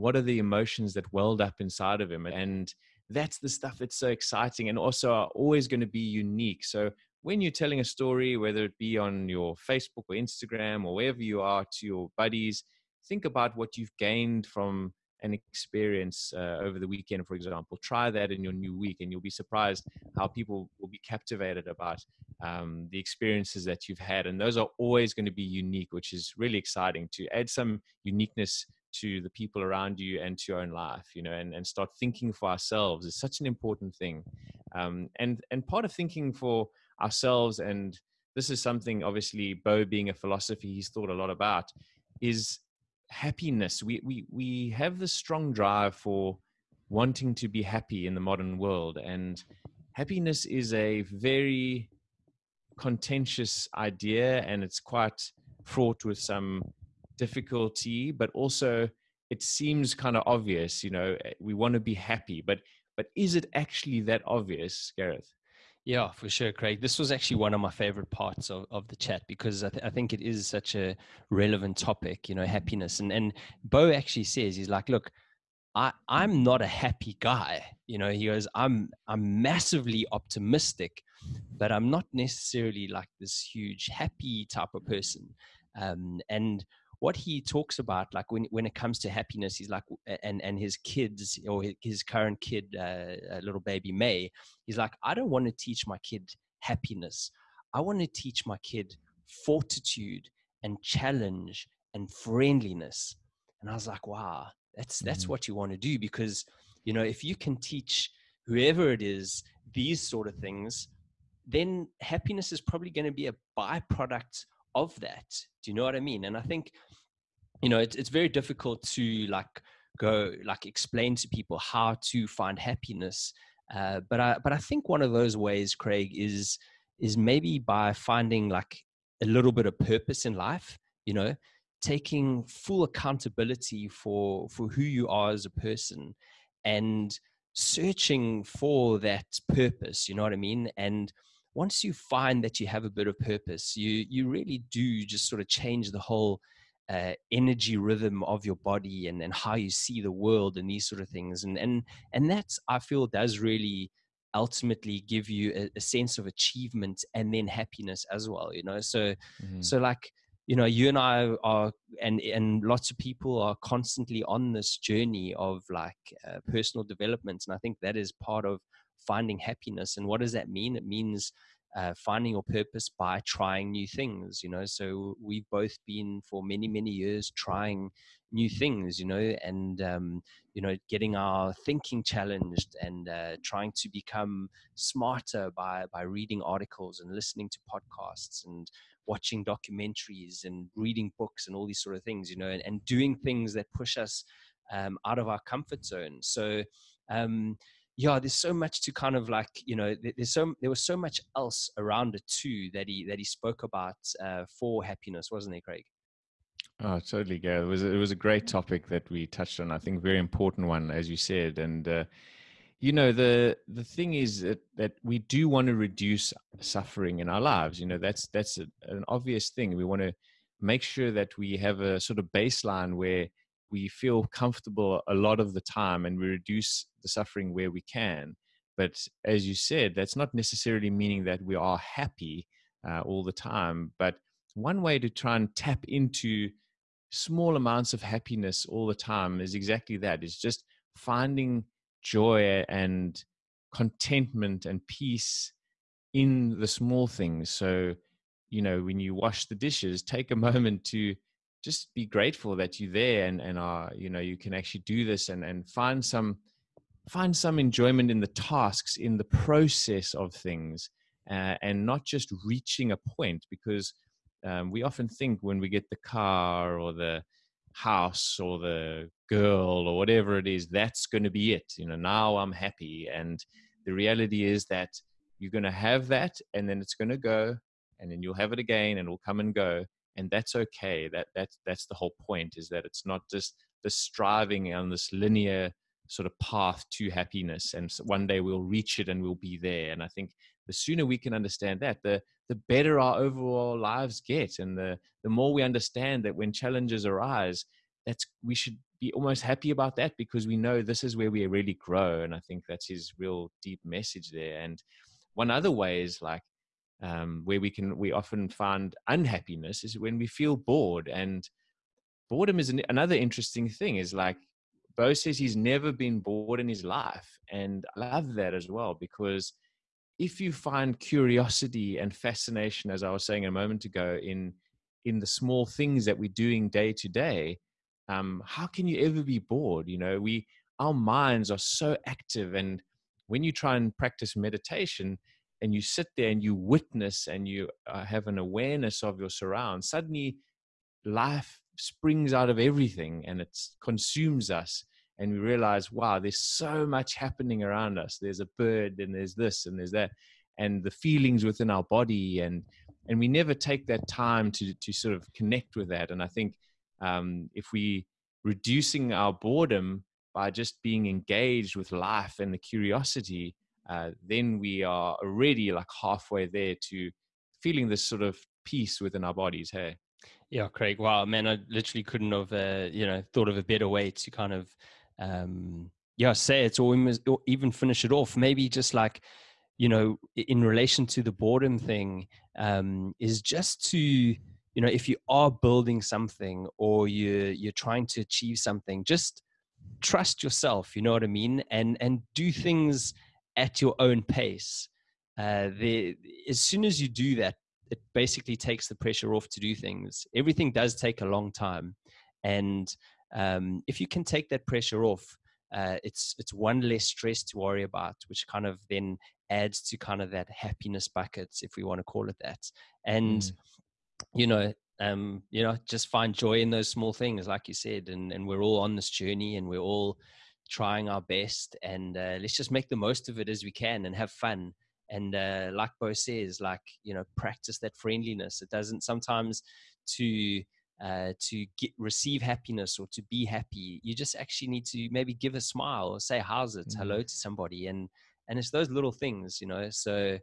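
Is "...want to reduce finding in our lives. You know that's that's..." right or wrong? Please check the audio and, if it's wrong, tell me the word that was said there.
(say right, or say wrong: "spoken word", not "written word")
wrong: "suffering", not "finding".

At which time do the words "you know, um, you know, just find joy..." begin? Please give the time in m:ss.
6:54.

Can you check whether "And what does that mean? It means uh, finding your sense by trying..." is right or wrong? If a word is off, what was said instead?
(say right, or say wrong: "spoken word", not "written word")
wrong: "purpose", not "sense".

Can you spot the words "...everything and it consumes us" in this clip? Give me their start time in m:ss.
5:42.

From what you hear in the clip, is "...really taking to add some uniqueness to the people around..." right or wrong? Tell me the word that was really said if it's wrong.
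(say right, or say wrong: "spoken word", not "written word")
wrong: "exciting", not "taking".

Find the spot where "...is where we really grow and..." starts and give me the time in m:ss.
5:01.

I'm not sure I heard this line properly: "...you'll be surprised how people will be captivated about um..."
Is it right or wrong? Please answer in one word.
right.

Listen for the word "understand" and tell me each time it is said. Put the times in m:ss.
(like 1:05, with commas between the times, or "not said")
4:51, 4:55.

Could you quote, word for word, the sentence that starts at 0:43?
We, we, we have this strong drive for wanting to be happy in the modern world.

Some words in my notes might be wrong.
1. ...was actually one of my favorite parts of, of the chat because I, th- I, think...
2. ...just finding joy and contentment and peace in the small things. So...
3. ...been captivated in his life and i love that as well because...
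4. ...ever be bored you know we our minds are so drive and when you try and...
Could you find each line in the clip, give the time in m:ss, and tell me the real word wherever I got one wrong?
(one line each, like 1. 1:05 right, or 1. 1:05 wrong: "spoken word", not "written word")
1. 1:06 right
2. 4:00 right
3. 5:15 wrong: "bored", not "captivated"
4. 5:29 wrong: "active", not "drive".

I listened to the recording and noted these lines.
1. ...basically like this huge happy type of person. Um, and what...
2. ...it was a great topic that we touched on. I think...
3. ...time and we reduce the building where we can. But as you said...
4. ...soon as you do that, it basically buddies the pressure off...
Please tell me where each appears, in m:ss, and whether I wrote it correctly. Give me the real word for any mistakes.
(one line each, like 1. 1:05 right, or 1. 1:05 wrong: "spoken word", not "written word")
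1. 1:22 wrong: "necessarily", not "basically"
2. 3:27 right
3. 3:45 wrong: "suffering", not "building"
4. 6:36 wrong: "takes", not "buddies".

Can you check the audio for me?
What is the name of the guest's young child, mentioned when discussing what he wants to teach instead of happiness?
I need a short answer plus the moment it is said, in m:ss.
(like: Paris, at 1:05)
May, at 1:33.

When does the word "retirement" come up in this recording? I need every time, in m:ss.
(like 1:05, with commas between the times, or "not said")
not said.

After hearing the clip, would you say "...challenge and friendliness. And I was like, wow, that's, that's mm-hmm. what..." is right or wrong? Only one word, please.
right.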